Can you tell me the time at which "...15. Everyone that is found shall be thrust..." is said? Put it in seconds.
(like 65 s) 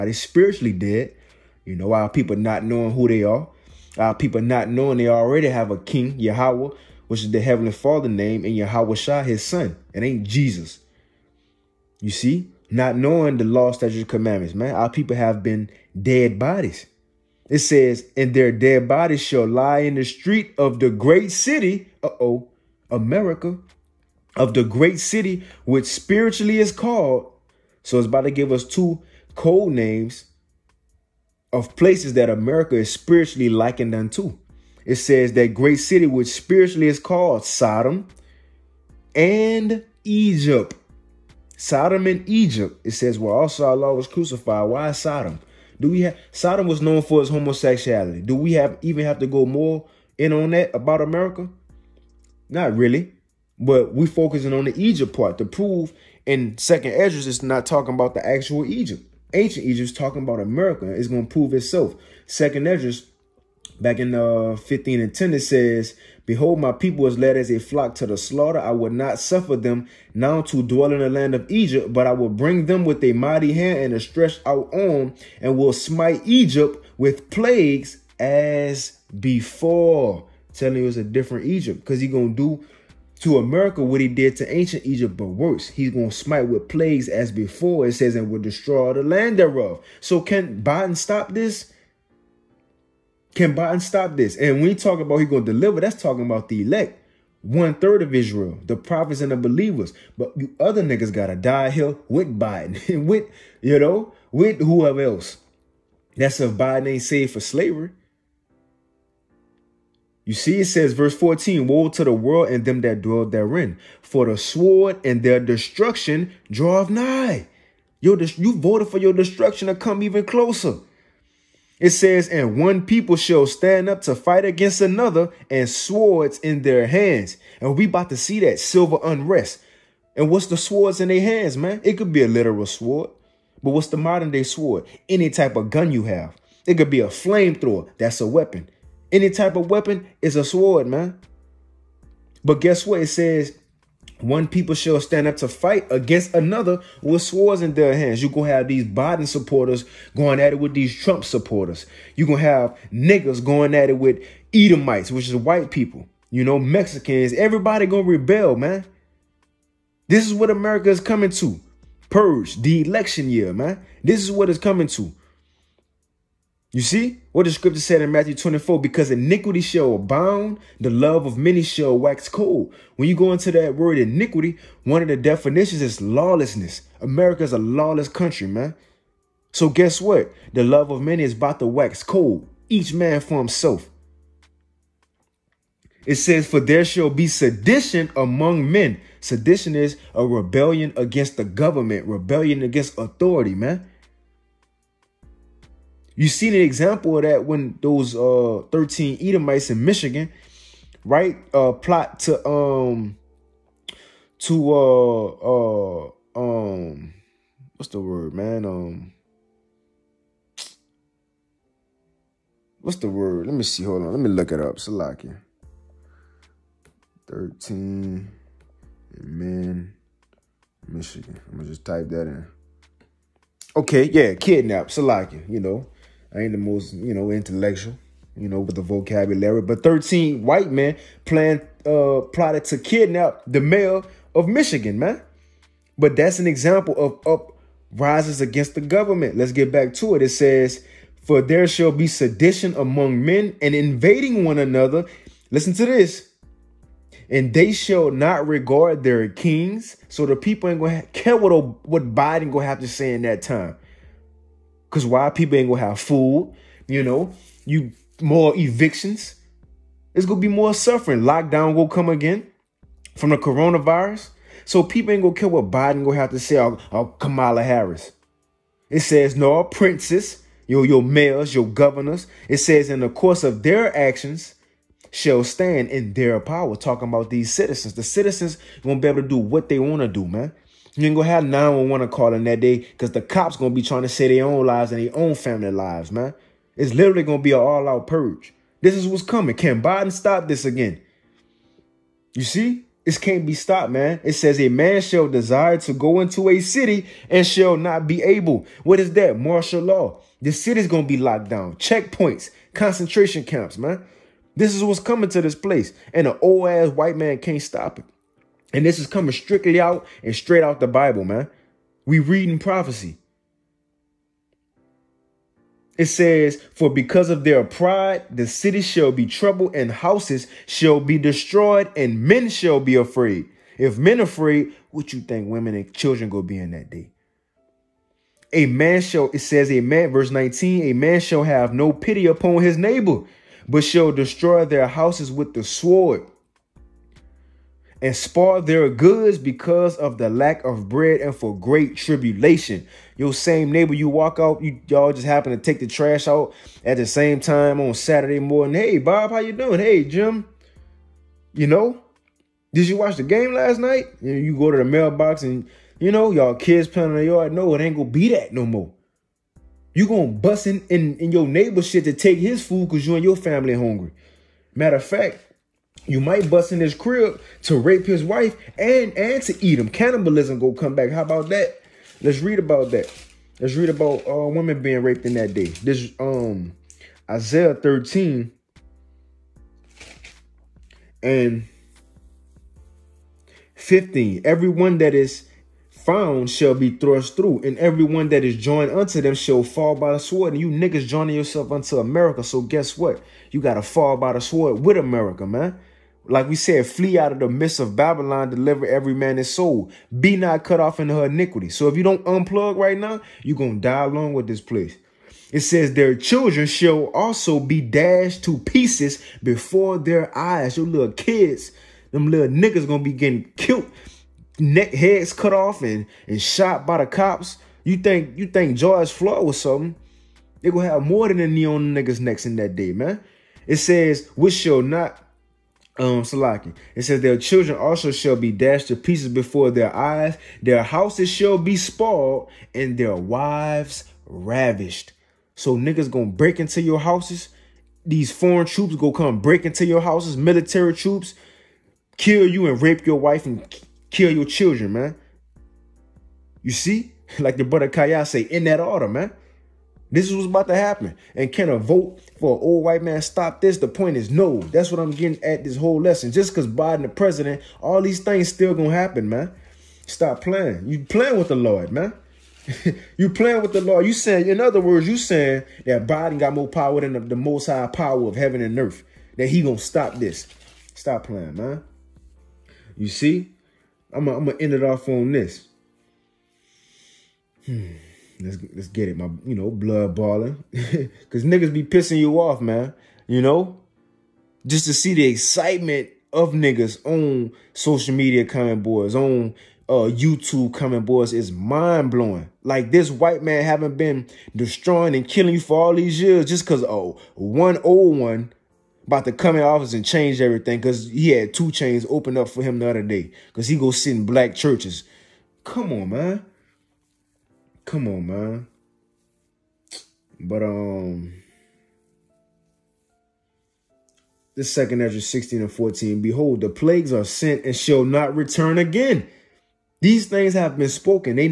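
383 s.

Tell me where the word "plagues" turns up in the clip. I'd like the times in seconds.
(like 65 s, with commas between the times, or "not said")
77 s, 86 s, 516 s.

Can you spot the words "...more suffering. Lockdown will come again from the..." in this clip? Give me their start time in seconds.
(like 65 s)
260 s.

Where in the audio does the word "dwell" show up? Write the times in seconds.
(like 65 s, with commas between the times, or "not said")
70 s, 113 s.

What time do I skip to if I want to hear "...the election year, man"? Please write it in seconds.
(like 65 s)
162 s.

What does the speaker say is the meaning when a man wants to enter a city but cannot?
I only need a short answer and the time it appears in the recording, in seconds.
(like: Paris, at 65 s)
Martial law, at 299 s.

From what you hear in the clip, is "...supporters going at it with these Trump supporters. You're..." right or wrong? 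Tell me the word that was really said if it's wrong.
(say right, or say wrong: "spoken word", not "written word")
right.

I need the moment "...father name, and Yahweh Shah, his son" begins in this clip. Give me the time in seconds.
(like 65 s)
7 s.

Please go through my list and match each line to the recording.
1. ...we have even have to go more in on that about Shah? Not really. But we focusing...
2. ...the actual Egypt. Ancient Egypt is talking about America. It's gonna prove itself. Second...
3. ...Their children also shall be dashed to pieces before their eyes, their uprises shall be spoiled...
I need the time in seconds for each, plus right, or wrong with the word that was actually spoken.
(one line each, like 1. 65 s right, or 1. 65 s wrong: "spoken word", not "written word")
1. 48 s wrong: "America", not "Shah"
2. 58 s right
3. 427 s wrong: "houses", not "uprises".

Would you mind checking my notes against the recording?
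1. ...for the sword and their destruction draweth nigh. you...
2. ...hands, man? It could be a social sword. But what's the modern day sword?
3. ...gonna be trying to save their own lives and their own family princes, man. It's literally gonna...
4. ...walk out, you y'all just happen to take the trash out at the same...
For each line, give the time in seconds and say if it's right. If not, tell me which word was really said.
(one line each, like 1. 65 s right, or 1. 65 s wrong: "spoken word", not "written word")
1. 114 s right
2. 131 s wrong: "literal", not "social"
3. 283 s wrong: "lives", not "princes"
4. 344 s right.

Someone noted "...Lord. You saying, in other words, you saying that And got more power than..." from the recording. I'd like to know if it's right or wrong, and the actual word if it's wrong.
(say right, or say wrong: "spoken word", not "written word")
wrong: "Biden", not "And".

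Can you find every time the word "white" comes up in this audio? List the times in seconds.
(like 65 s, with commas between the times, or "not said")
155 s, 230 s, 306 s, 452 s, 493 s.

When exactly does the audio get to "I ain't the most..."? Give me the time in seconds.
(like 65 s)
226 s.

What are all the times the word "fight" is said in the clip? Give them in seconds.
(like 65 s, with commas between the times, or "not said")
124 s, 145 s.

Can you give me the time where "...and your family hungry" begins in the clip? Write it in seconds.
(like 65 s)
363 s.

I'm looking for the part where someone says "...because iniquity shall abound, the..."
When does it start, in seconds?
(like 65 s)
168 s.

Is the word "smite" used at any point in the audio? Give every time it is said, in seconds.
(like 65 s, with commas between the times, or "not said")
75 s, 86 s.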